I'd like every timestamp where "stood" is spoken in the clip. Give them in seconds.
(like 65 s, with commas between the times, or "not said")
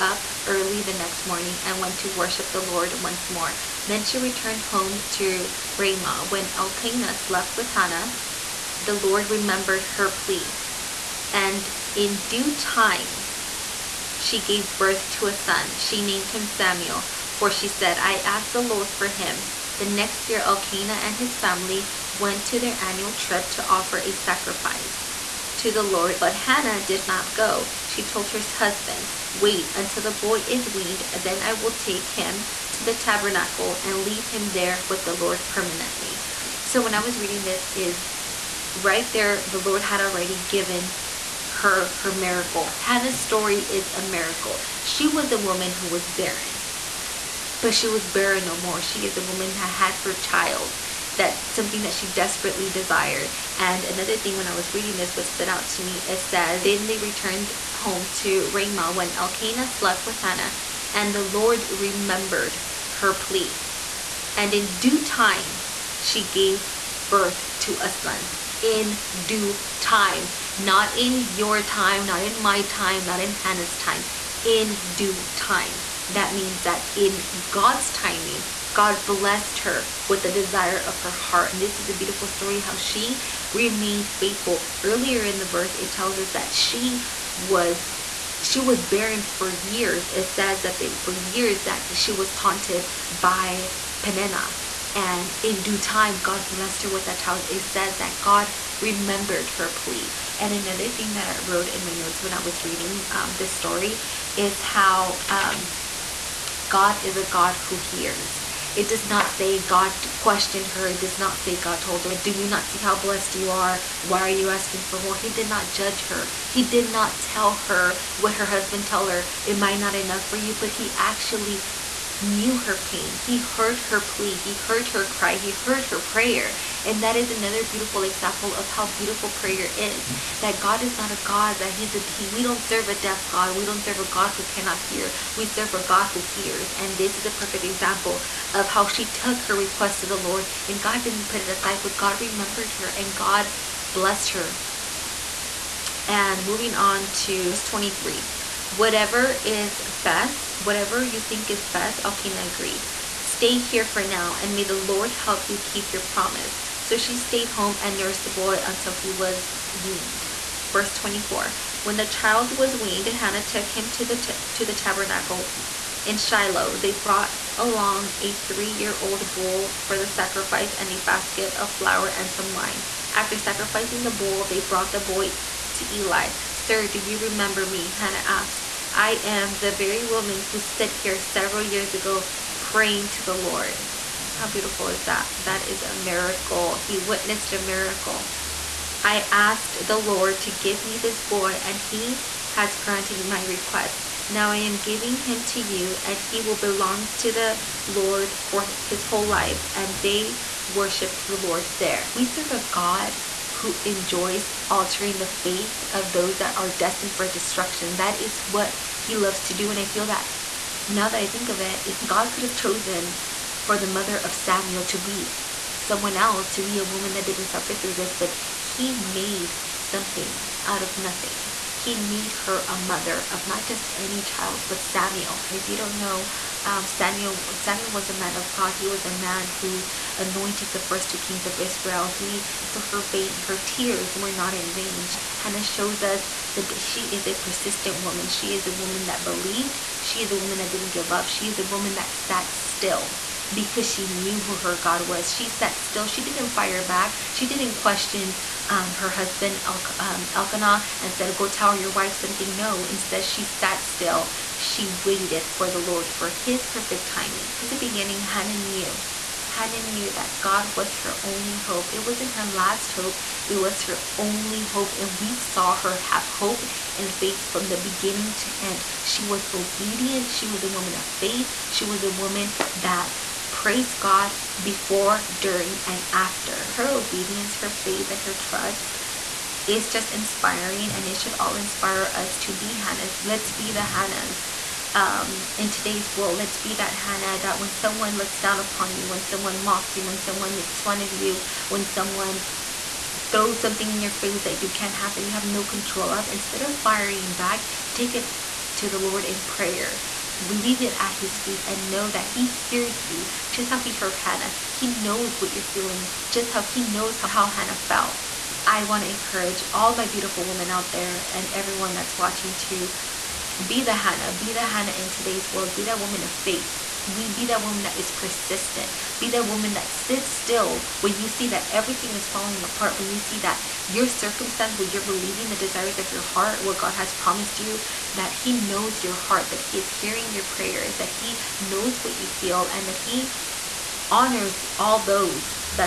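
55 s, 180 s.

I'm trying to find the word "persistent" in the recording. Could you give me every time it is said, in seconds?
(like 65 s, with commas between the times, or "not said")
237 s, 318 s.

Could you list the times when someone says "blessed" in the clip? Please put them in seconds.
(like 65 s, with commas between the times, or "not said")
79 s, 96 s, 112 s, 143 s.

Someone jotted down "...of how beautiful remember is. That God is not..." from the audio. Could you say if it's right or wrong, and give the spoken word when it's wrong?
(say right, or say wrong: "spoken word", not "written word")
wrong: "prayer", not "remember".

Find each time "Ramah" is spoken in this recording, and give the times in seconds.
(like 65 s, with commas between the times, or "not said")
5 s, 58 s.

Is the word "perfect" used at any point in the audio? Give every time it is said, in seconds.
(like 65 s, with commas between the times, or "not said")
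137 s, 256 s.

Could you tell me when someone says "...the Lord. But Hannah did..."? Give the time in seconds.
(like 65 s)
25 s.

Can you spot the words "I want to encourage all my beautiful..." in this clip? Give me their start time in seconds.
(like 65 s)
308 s.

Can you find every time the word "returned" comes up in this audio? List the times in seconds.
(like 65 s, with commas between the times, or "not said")
4 s, 56 s.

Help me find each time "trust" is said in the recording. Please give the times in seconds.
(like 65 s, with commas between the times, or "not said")
278 s.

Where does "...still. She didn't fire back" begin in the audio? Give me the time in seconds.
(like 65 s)
245 s.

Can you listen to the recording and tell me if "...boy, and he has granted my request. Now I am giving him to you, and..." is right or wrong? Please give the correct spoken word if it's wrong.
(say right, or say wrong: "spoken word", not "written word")
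right.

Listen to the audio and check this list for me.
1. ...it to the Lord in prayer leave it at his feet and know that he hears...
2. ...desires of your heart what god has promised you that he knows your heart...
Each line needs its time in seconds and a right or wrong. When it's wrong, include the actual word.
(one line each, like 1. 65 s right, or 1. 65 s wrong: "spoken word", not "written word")
1. 298 s right
2. 325 s right.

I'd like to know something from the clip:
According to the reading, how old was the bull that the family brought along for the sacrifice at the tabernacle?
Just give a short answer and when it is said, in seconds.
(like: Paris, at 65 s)
3 years old, at 168 s.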